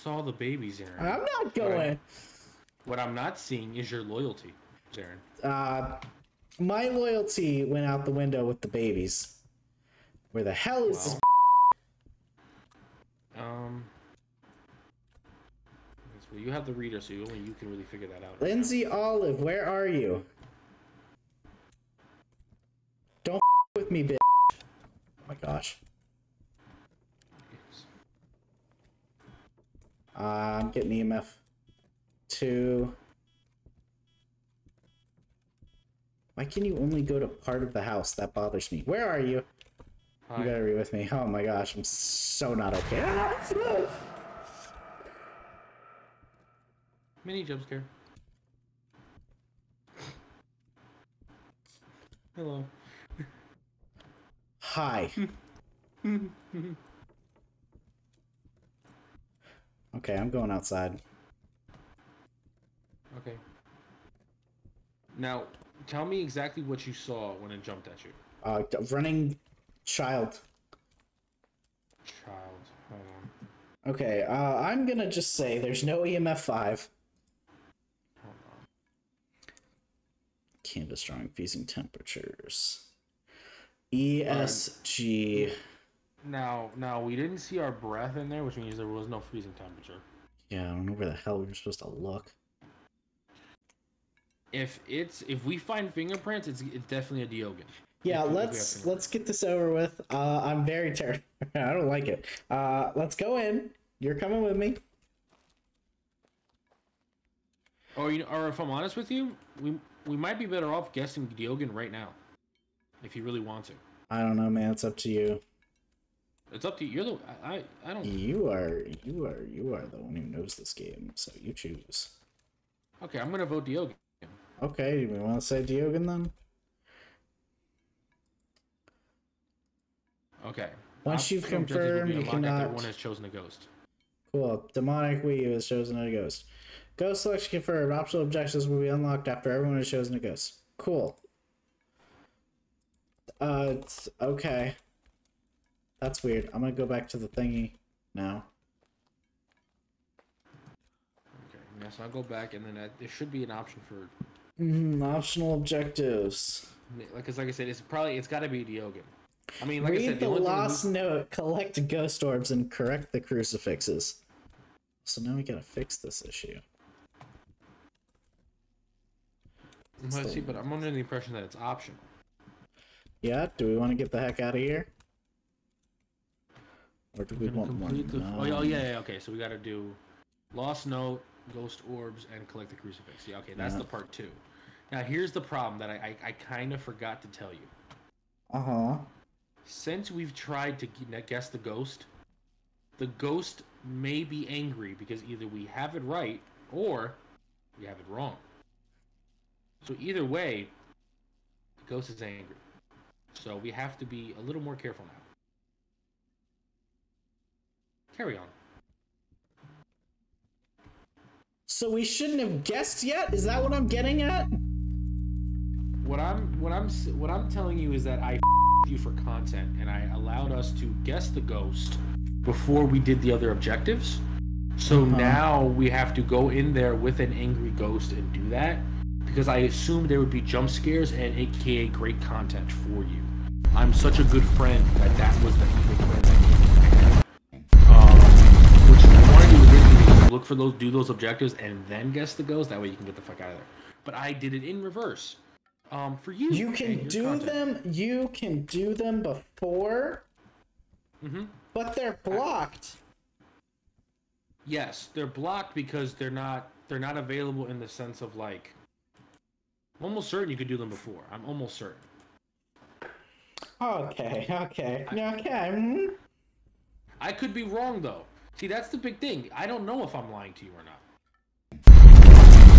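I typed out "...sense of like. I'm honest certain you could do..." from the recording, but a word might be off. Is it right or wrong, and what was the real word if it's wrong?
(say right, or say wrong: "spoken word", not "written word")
wrong: "almost", not "honest".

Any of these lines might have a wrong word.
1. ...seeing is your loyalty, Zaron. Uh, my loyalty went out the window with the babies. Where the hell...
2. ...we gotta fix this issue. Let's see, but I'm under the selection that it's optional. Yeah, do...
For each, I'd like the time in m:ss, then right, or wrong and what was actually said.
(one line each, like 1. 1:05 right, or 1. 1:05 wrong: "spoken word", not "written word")
1. 0:03 right
2. 2:45 wrong: "impression", not "selection".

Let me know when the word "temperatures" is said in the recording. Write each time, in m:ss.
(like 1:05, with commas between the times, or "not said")
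1:21, 1:29.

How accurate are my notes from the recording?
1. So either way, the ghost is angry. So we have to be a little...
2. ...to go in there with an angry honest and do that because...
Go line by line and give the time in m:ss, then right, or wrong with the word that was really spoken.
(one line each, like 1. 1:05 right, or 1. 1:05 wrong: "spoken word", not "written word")
1. 3:19 right
2. 3:46 wrong: "ghost", not "honest".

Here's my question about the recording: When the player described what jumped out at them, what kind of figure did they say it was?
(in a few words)
Running child.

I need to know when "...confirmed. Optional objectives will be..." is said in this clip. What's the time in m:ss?
2:17.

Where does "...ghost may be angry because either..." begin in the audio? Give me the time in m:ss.
3:13.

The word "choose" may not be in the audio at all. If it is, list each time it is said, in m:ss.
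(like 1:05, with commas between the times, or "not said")
2:01.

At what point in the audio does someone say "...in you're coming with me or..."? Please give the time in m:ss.
1:43.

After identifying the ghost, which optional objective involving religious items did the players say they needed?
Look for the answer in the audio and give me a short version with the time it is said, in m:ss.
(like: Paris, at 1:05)
Collect the crucifix, at 3:02.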